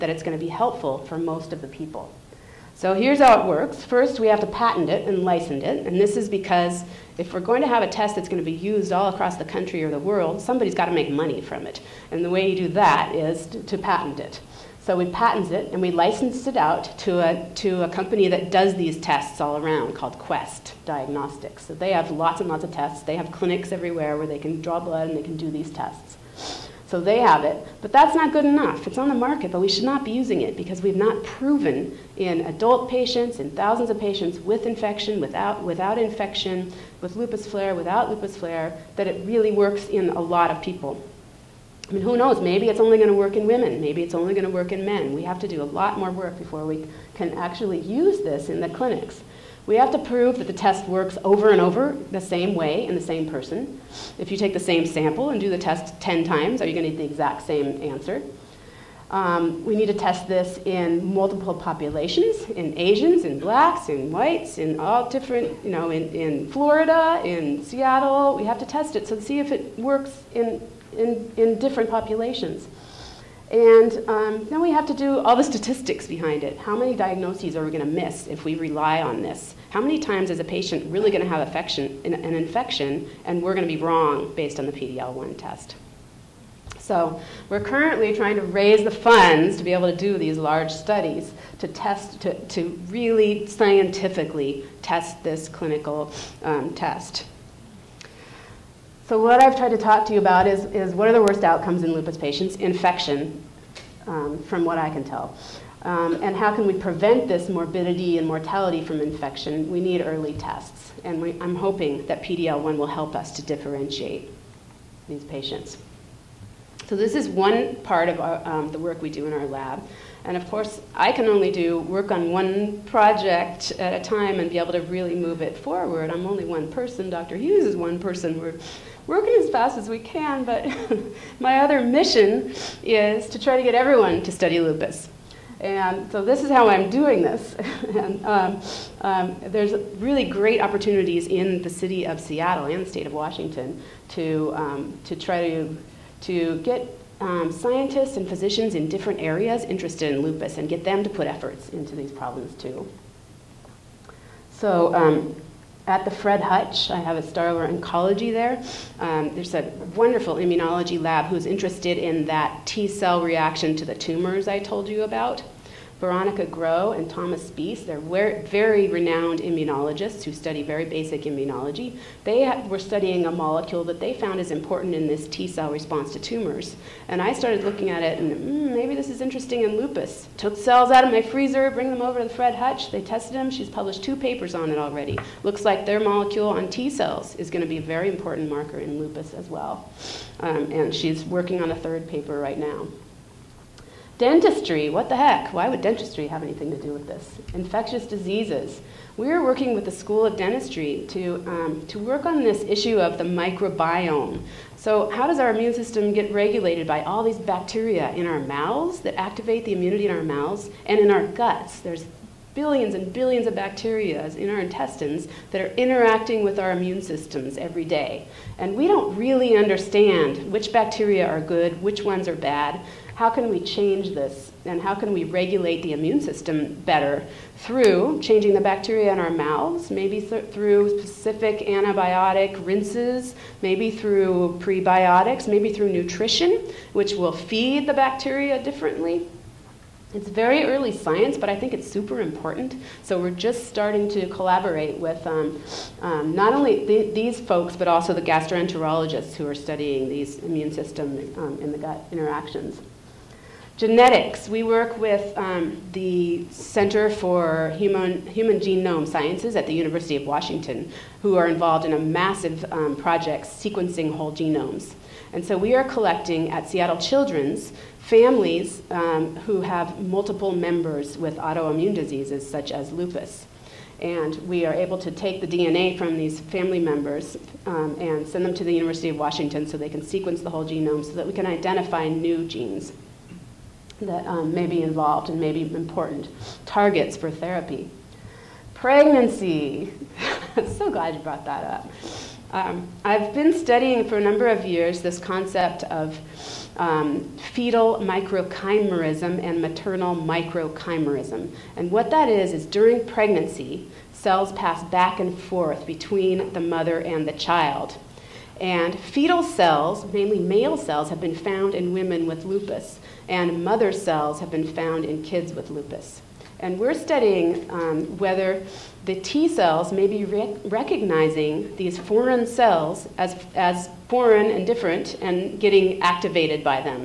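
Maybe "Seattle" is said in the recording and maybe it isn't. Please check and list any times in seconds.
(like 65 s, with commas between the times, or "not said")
67 s, 142 s, 266 s.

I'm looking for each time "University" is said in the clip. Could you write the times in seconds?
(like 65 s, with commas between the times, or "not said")
259 s, 278 s.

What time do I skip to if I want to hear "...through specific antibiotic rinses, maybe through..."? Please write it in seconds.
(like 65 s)
230 s.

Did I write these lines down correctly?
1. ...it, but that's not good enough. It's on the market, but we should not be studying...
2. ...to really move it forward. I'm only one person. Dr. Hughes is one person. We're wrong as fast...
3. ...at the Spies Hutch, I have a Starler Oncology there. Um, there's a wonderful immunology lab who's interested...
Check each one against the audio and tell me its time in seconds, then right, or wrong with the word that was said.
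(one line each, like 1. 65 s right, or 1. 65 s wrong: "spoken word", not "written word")
1. 27 s wrong: "using", not "studying"
2. 124 s wrong: "working", not "wrong"
3. 155 s wrong: "Fred", not "Spies".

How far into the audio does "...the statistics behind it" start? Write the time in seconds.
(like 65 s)
75 s.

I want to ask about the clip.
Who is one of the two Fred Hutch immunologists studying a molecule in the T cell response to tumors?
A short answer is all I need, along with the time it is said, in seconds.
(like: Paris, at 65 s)
Veronica Groh, at 166 s.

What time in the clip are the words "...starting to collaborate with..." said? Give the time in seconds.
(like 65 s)
243 s.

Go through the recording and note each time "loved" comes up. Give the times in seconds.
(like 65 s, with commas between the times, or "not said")
not said.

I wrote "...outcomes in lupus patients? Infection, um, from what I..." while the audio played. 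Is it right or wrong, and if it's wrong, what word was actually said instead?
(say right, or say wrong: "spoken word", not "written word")
right.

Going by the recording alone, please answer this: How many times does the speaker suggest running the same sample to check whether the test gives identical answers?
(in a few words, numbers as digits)
10.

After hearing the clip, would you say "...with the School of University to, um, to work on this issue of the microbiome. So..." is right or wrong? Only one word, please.
wrong.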